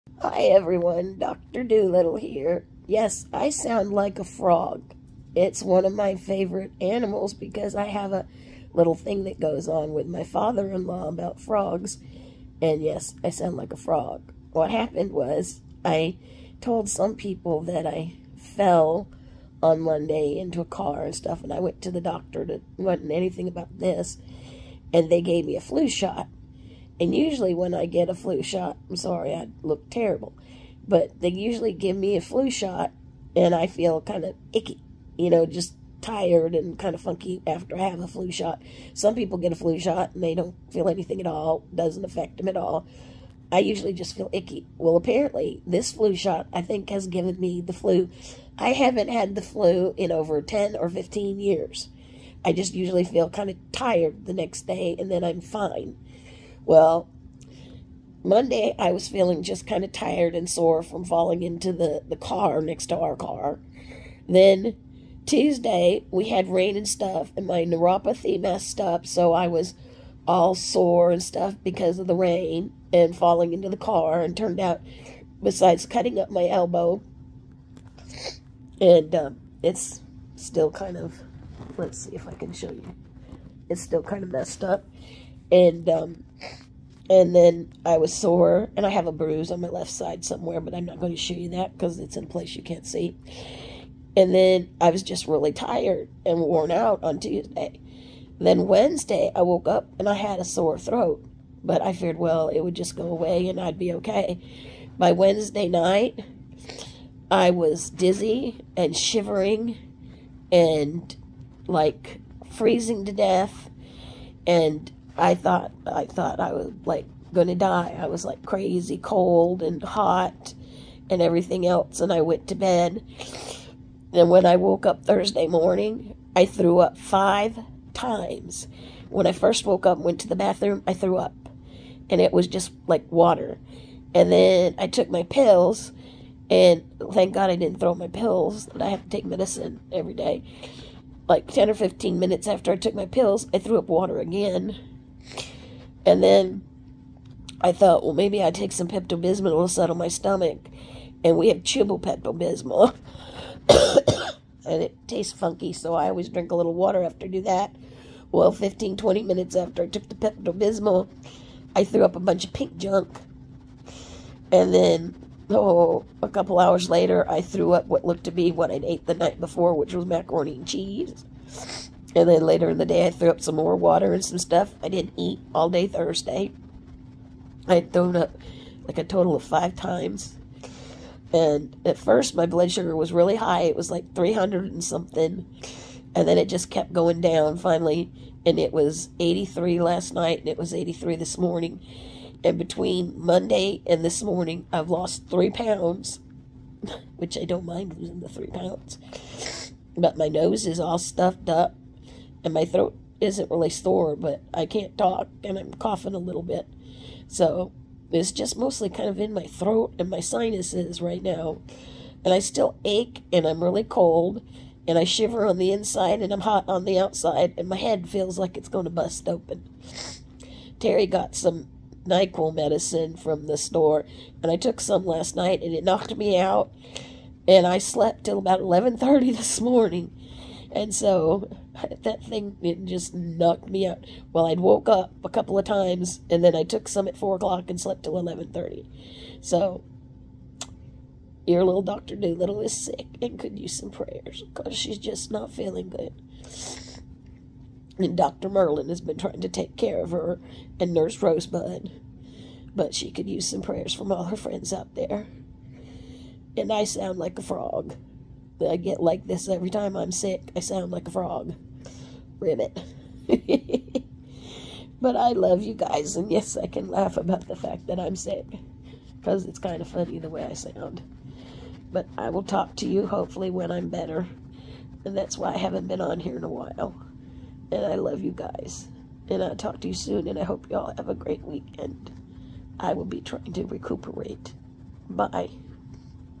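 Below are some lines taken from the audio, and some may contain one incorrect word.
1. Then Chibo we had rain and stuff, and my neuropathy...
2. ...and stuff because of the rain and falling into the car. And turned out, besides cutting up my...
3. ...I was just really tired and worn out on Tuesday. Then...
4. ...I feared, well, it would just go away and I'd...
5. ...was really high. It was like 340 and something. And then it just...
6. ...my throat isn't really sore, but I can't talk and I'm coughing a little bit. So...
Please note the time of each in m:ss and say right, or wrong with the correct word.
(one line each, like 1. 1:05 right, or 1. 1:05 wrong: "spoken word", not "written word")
1. 1:04 wrong: "Tuesday", not "Chibo"
2. 1:11 right
3. 1:34 right
4. 1:41 right
5. 3:02 wrong: "300", not "340"
6. 3:22 right.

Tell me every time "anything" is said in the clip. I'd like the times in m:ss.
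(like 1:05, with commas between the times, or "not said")
0:23, 0:40.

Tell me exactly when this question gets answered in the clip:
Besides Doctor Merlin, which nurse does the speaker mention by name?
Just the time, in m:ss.
4:10.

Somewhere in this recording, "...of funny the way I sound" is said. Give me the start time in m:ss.
4:29.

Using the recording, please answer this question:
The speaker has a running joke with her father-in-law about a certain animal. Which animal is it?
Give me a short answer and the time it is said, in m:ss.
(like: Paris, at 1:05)
frogs, at 0:11.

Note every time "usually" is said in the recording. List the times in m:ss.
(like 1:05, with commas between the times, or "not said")
0:27, 0:31, 0:43, 0:52.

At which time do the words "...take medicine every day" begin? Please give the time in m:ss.
2:19.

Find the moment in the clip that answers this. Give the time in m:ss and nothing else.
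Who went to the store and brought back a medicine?
3:40.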